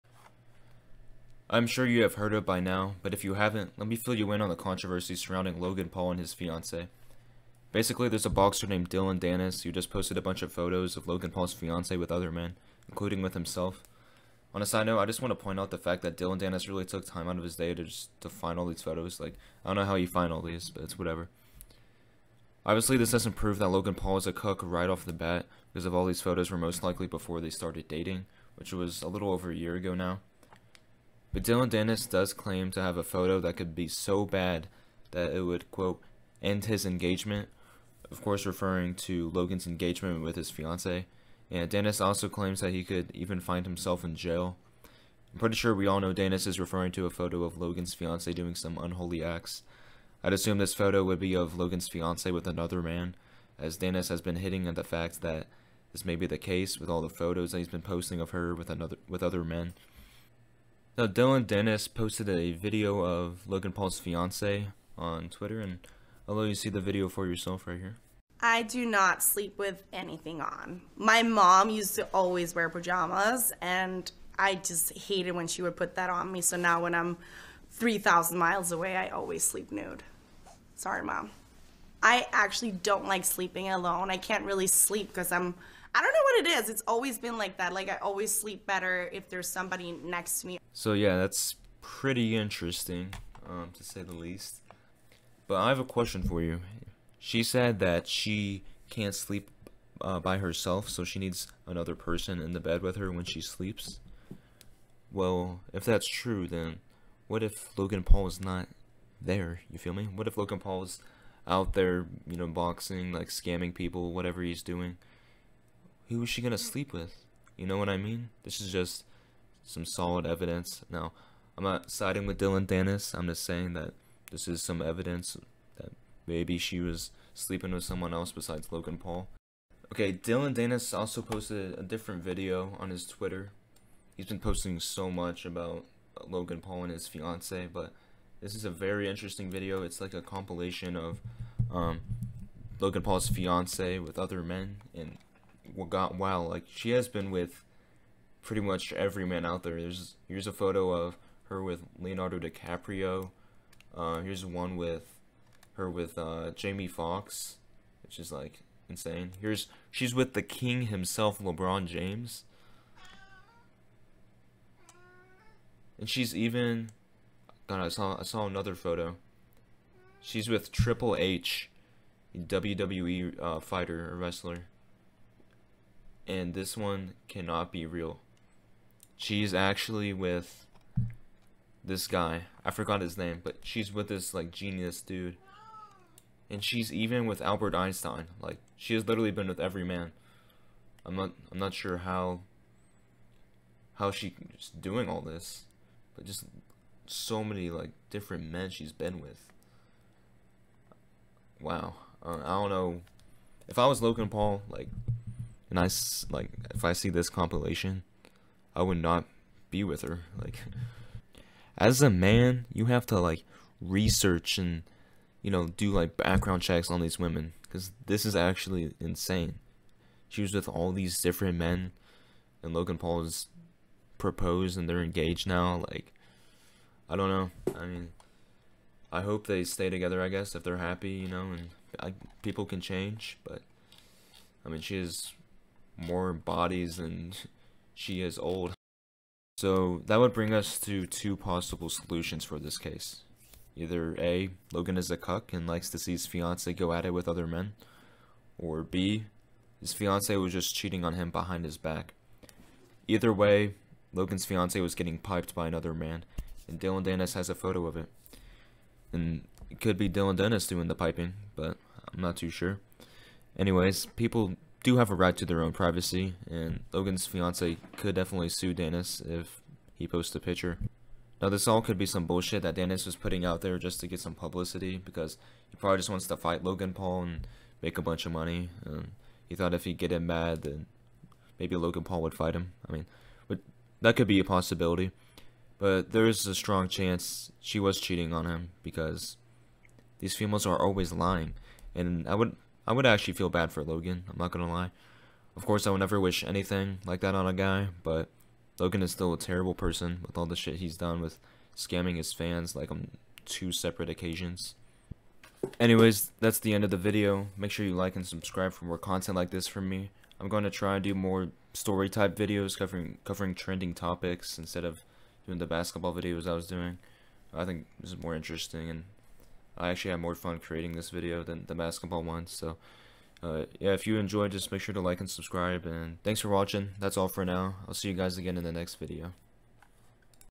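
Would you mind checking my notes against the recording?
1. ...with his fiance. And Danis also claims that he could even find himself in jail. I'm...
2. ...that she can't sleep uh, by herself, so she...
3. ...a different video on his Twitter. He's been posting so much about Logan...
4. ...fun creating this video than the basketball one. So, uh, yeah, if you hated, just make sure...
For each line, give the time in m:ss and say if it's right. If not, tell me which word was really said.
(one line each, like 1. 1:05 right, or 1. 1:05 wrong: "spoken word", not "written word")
1. 0:40 right
2. 1:37 right
3. 2:11 right
4. 5:20 wrong: "enjoyed", not "hated".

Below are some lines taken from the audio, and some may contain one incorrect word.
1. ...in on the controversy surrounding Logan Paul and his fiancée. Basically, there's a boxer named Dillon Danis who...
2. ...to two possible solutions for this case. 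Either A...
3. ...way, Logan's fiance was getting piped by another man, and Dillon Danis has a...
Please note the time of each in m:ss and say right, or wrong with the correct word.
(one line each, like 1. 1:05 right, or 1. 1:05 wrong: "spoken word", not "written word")
1. 0:04 right
2. 4:00 right
3. 4:13 right.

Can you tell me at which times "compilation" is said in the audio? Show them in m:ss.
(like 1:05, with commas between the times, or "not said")
2:20, 3:27.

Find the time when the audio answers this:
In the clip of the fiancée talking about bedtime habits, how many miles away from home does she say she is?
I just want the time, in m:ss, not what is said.
1:17.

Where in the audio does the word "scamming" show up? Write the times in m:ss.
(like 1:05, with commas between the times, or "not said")
1:53, 5:01.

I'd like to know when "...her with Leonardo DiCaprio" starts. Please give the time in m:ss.
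2:31.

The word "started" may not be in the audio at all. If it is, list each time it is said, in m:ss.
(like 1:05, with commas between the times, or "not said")
0:27.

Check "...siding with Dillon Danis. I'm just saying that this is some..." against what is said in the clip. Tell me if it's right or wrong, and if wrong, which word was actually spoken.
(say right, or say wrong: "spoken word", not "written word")
right.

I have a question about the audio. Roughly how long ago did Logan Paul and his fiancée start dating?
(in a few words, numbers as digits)
A little over a year.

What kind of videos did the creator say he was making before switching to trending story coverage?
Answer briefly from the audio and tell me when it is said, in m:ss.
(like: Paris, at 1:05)
Basketball videos, at 5:15.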